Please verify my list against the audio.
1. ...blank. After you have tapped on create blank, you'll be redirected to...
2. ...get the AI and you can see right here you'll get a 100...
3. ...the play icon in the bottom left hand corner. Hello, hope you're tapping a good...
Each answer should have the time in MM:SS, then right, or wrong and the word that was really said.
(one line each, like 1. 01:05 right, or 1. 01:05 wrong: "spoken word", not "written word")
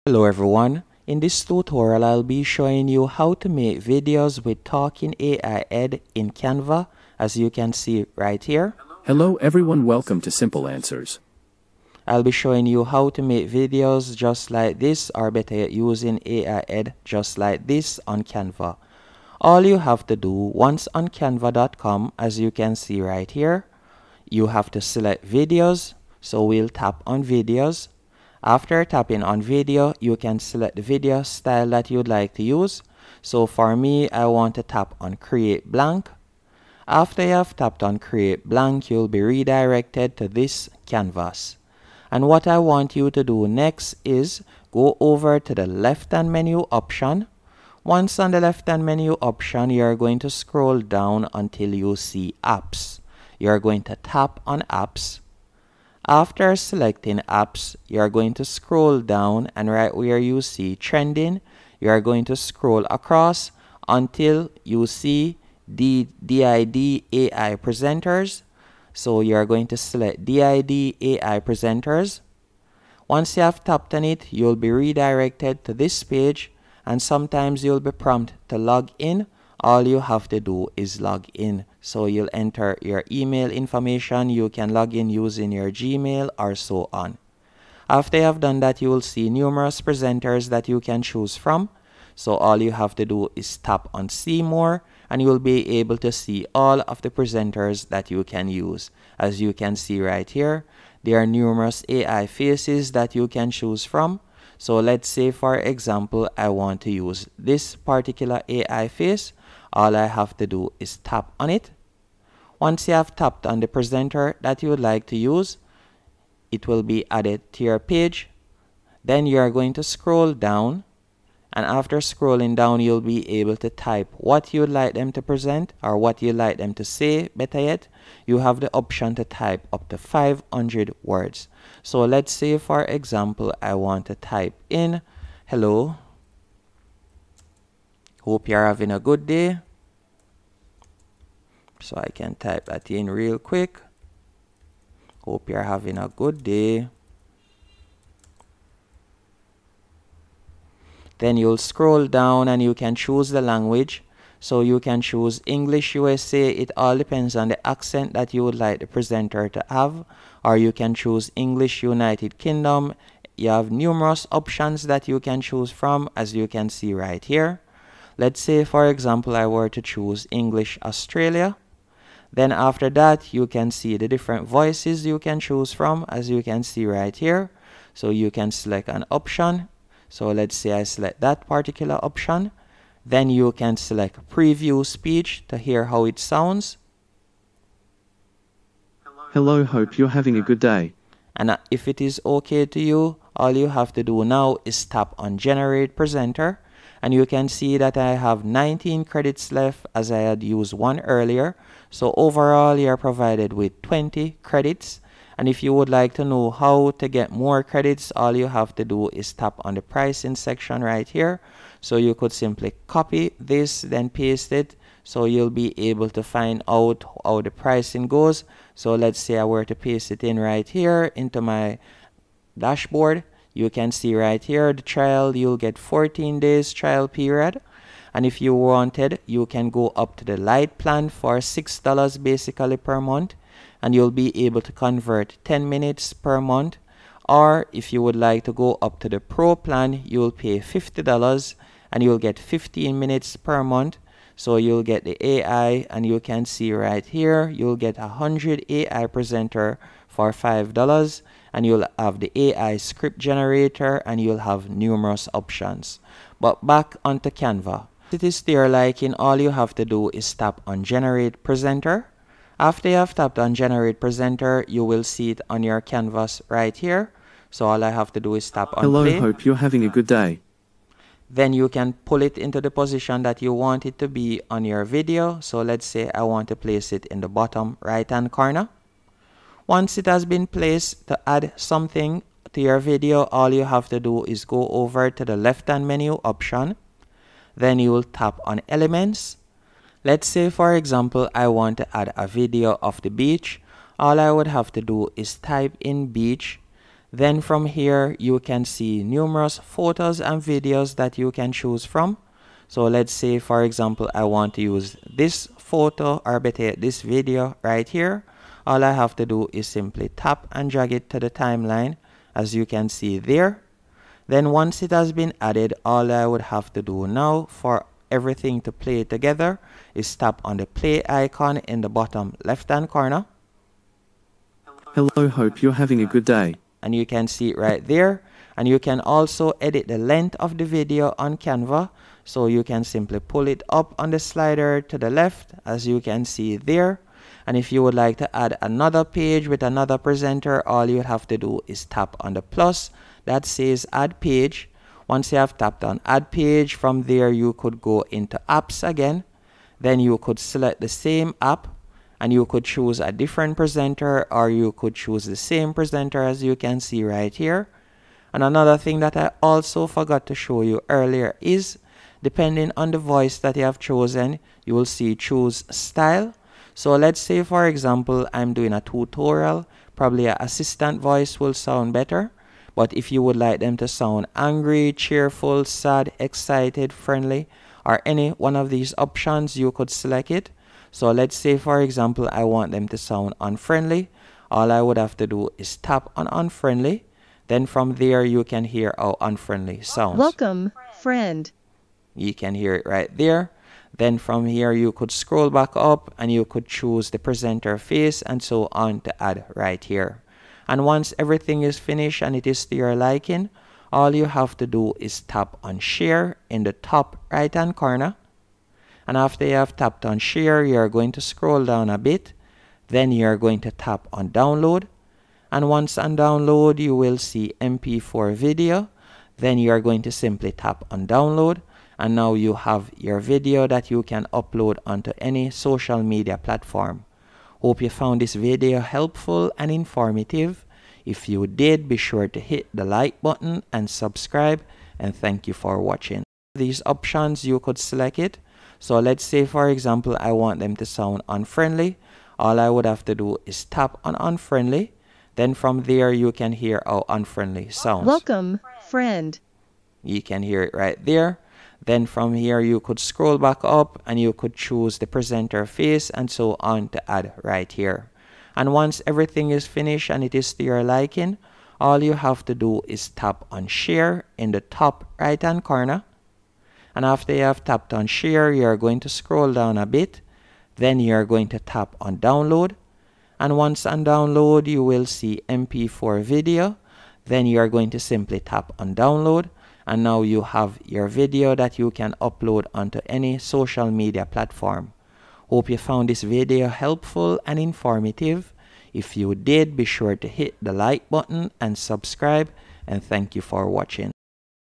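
1. 00:35 right
2. 04:04 right
3. 05:20 wrong: "having", not "tapping".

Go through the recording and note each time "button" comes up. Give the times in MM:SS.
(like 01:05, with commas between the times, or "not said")
07:13, 08:11.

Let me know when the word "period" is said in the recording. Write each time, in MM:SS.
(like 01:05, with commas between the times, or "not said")
03:47.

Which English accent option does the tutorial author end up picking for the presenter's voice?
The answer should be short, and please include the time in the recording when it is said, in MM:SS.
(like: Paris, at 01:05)
English Australia, at 02:50.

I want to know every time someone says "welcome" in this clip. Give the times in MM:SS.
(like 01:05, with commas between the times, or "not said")
00:09, 06:30, 07:28.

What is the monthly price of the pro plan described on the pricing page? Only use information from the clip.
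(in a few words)
$50.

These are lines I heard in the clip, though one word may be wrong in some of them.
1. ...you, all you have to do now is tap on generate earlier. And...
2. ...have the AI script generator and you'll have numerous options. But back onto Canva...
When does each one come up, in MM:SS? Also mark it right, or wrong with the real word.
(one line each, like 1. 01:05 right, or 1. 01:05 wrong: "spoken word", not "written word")
1. 03:12 wrong: "presenter", not "earlier"
2. 04:11 right.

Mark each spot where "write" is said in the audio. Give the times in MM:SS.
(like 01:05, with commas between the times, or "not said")
not said.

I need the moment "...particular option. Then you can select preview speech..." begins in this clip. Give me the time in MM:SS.
03:01.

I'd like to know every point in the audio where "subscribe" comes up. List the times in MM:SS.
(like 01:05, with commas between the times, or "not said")
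07:13, 08:11.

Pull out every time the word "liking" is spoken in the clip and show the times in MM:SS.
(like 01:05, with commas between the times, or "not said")
06:42, 07:40.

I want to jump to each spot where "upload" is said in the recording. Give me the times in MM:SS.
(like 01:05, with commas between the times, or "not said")
07:04, 08:02.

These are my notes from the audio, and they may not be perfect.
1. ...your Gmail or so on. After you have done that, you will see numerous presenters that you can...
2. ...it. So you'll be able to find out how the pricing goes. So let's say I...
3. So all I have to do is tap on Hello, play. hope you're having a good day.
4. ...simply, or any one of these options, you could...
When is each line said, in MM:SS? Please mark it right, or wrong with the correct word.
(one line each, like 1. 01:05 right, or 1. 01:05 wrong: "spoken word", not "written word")
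1. 01:25 right
2. 03:34 right
3. 04:27 right
4. 06:16 wrong: "friendly", not "simply".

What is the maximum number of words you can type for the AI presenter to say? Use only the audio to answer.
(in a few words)
500.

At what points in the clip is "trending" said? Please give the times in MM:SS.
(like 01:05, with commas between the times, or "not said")
01:00.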